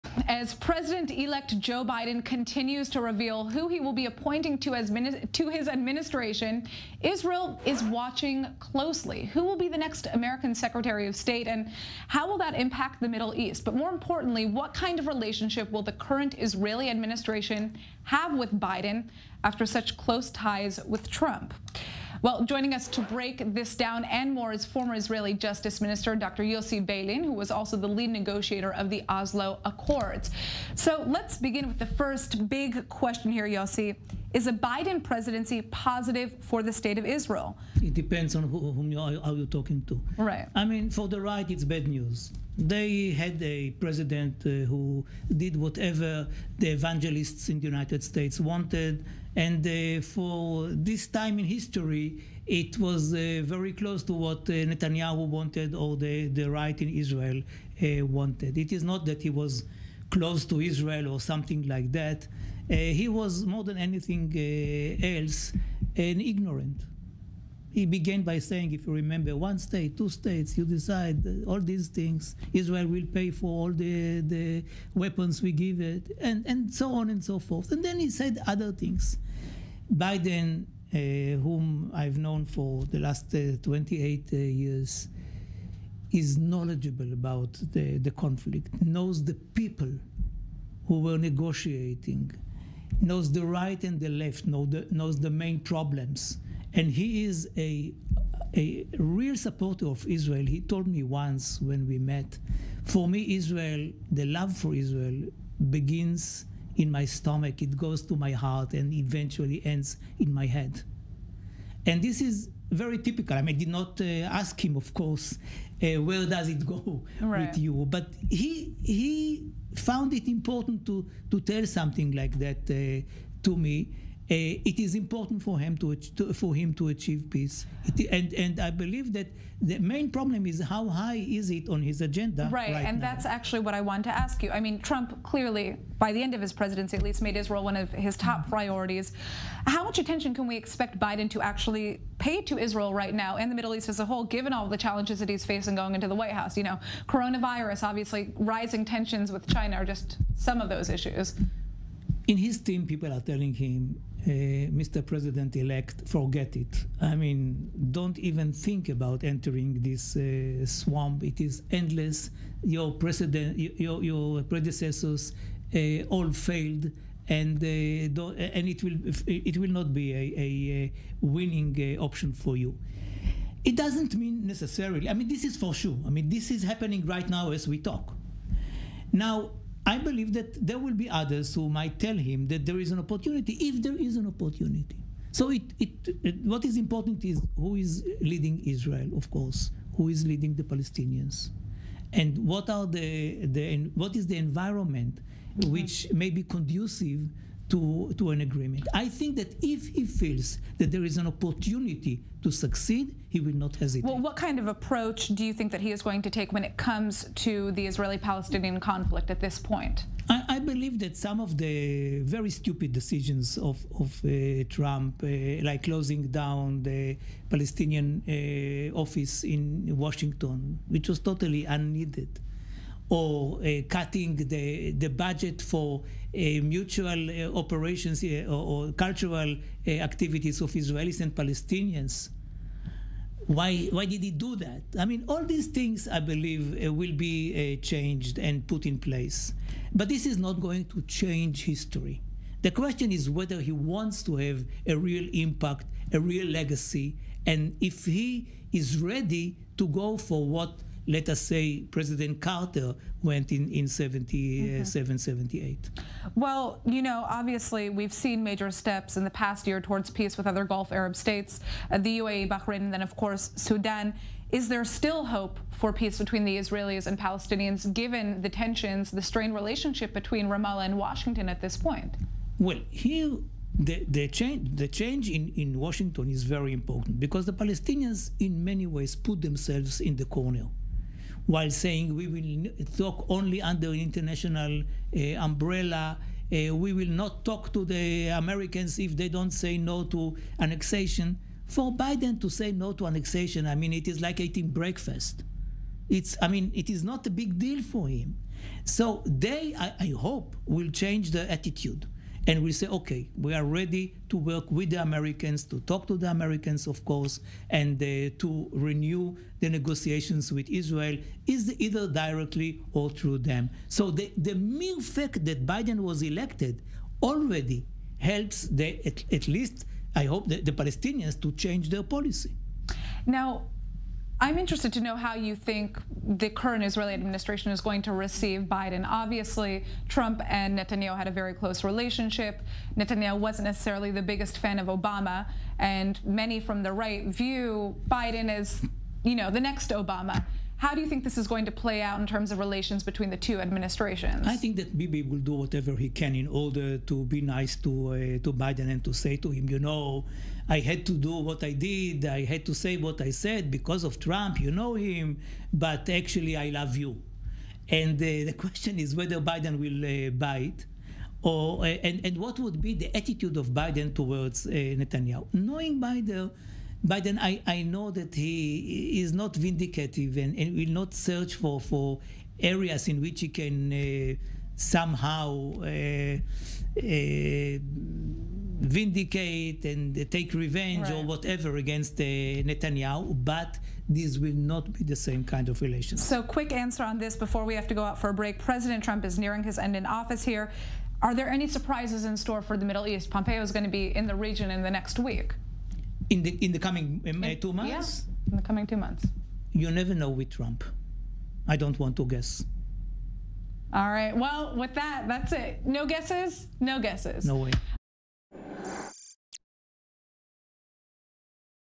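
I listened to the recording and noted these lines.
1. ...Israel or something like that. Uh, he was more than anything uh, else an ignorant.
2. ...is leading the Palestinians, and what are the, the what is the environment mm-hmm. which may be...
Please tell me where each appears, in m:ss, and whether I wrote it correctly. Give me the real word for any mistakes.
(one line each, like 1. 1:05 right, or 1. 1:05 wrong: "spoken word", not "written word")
1. 1:00 right
2. 3:10 right.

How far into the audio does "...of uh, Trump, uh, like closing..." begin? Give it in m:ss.
3:33.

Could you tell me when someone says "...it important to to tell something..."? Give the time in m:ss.
2:00.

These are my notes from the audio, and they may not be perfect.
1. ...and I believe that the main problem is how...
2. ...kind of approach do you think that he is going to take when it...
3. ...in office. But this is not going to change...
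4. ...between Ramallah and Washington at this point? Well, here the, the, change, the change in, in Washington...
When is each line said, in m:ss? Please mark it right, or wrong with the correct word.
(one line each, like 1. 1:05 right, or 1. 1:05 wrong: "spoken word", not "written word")
1. 2:08 right
2. 3:24 right
3. 3:58 wrong: "place", not "office"
4. 4:30 right.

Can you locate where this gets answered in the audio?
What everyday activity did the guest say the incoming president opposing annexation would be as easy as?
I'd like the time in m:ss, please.
4:54.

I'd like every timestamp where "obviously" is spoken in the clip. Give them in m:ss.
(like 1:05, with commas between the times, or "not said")
2:27, 4:17, 5:29.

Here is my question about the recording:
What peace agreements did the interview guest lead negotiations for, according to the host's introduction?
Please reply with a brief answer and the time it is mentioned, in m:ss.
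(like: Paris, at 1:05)
Oslo Accords, at 0:29.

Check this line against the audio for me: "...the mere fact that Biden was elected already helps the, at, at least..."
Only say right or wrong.
right.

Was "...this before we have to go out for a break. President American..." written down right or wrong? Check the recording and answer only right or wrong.
wrong.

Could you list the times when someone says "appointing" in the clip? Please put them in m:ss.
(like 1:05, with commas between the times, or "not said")
0:04.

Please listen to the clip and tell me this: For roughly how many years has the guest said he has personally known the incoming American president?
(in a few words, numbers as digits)
28.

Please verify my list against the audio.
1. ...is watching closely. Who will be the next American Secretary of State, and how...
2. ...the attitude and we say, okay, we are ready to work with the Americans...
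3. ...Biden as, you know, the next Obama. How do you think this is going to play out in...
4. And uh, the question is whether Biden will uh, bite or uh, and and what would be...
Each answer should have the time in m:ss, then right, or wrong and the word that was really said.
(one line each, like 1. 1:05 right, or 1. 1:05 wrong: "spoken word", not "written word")
1. 0:07 right
2. 5:01 right
3. 5:38 right
4. 5:57 right.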